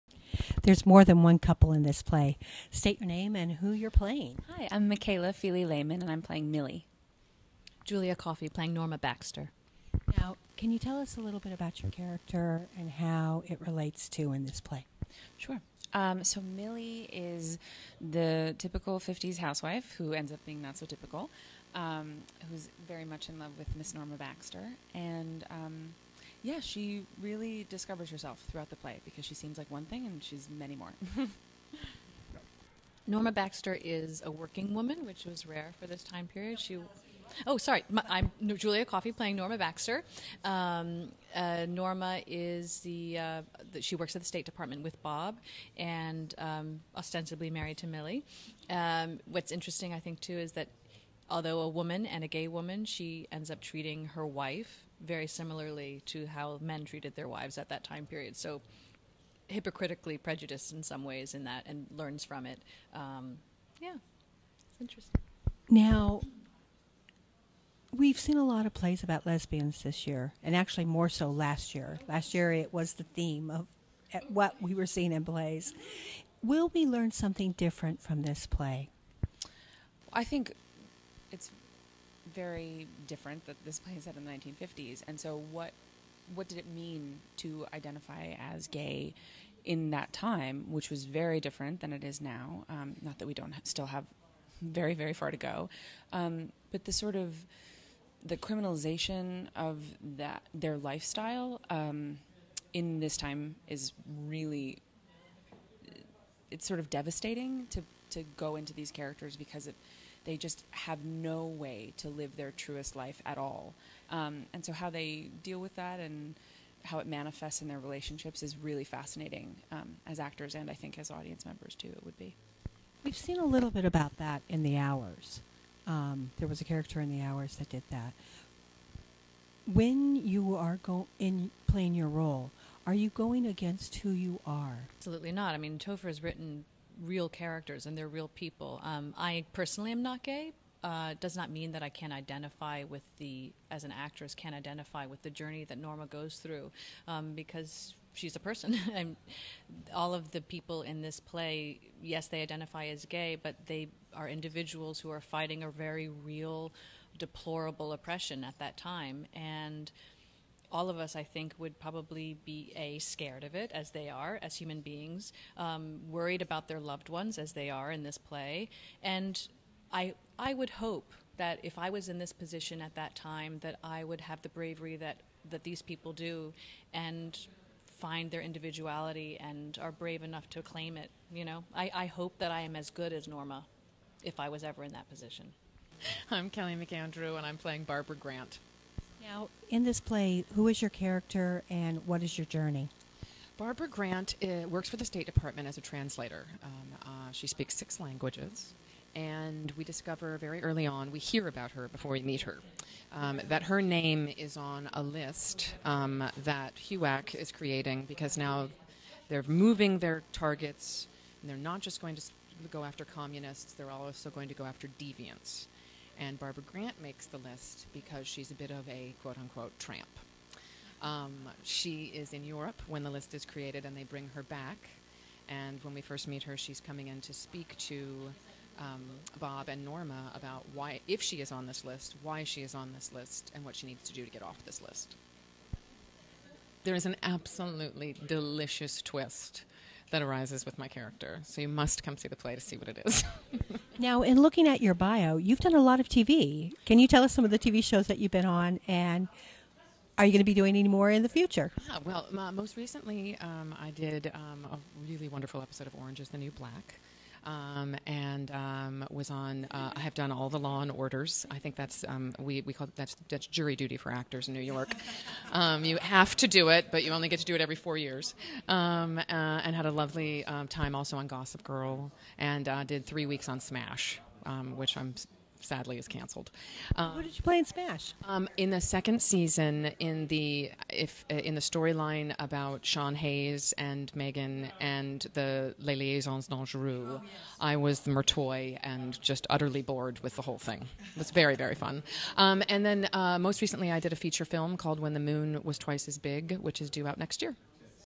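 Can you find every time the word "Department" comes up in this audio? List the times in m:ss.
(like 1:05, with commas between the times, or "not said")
0:44, 3:15.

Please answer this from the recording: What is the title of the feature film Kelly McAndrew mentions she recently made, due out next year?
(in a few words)
When the Moon Was Twice as Big.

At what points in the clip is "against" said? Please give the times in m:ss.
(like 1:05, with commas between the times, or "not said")
2:13.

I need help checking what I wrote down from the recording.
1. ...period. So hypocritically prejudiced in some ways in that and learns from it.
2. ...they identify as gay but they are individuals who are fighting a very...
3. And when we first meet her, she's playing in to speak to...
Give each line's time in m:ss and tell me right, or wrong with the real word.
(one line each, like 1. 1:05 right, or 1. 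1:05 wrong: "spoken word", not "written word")
1. 0:58 right
2. 2:32 right
3. 3:45 wrong: "coming", not "playing".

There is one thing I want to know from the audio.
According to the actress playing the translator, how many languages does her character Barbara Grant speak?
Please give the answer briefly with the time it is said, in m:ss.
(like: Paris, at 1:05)
6, at 3:17.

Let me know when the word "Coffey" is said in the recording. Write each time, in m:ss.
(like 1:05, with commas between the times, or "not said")
0:08, 0:38.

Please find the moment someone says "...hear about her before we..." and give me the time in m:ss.
3:21.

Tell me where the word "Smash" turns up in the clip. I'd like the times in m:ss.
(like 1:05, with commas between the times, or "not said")
4:33, 4:37.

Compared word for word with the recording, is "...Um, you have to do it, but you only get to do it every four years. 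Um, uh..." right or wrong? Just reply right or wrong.
right.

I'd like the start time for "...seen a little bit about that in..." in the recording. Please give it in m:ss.
2:03.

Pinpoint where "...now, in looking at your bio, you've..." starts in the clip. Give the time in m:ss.
4:03.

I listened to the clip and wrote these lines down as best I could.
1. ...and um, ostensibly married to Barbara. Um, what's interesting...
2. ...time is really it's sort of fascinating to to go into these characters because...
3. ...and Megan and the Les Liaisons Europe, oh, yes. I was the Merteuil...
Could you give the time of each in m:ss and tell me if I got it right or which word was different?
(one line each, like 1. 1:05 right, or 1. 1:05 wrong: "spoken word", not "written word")
1. 0:45 wrong: "Millie", not "Barbara"
2. 1:43 wrong: "devastating", not "fascinating"
3. 4:43 wrong: "Dangereuses", not "Europe".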